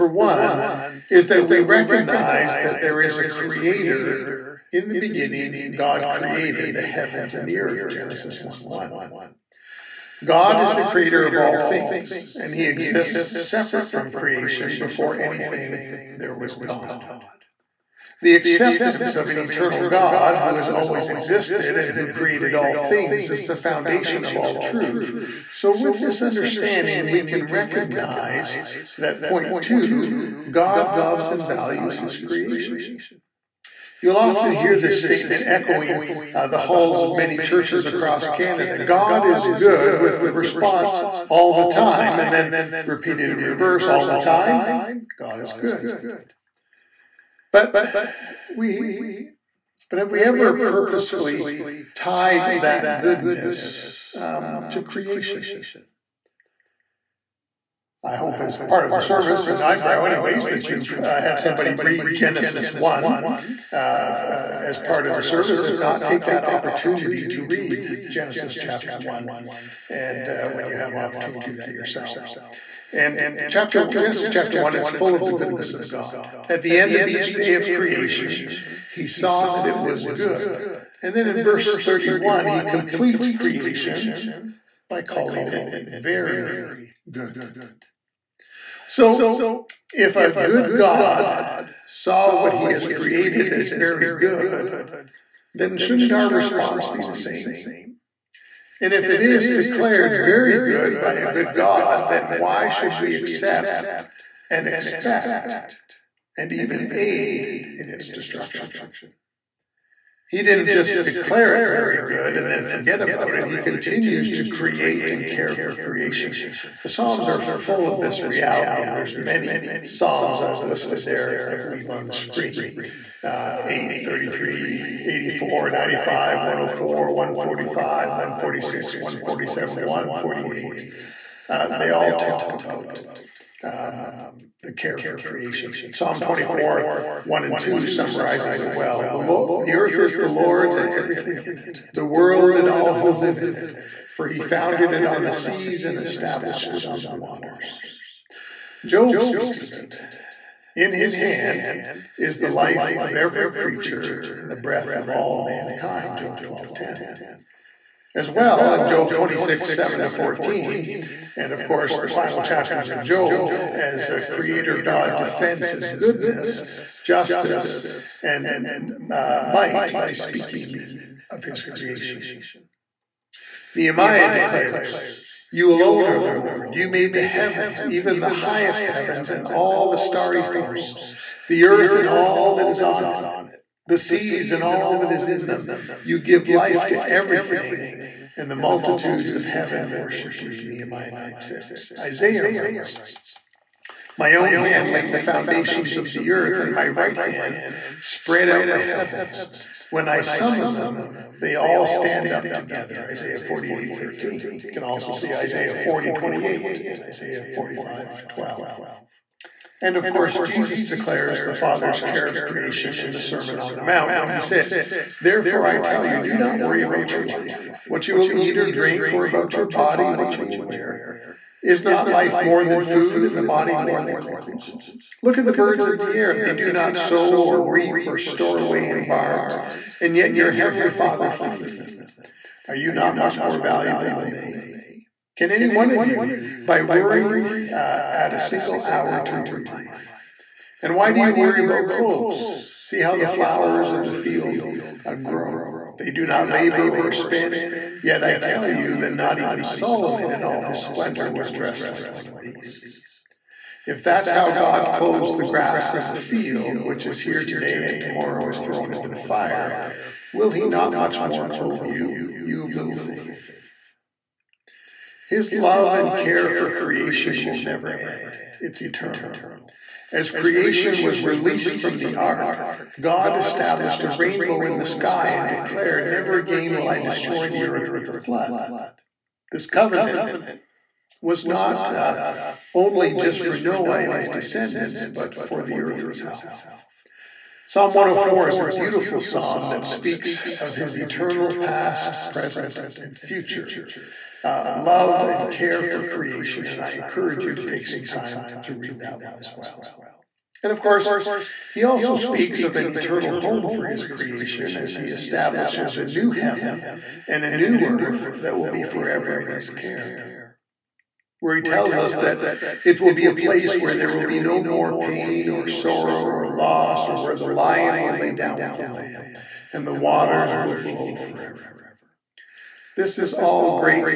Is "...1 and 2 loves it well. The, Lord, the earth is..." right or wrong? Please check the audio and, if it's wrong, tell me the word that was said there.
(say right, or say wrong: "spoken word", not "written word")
wrong: "summarizes", not "loves".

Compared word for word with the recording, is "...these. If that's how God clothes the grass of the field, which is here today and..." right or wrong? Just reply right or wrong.
right.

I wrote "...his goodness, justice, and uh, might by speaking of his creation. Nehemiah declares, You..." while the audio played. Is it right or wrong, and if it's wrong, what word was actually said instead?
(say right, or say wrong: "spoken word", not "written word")
right.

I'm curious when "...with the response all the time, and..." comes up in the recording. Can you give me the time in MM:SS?
00:39.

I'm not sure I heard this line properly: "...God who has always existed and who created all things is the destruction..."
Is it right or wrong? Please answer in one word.
wrong.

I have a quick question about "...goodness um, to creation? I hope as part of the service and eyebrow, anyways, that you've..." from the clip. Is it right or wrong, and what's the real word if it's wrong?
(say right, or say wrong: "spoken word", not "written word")
right.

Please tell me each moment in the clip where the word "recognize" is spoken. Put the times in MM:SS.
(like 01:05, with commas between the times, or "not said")
00:01, 00:27.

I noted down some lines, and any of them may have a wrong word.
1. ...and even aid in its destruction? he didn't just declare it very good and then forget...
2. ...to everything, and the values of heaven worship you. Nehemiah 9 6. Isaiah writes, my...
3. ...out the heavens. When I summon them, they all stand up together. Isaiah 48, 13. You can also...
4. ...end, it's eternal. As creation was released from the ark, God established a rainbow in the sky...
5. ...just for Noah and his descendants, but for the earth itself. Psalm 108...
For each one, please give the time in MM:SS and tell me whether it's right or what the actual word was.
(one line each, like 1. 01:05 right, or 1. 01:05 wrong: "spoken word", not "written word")
1. 01:46 right
2. 03:06 wrong: "multitudes", not "values"
3. 03:18 right
4. 04:27 right
5. 04:43 wrong: "104", not "108".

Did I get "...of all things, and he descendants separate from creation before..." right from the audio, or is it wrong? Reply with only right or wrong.
wrong.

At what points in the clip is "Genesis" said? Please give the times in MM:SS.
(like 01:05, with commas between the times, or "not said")
00:07, 01:02, 01:08, 01:13.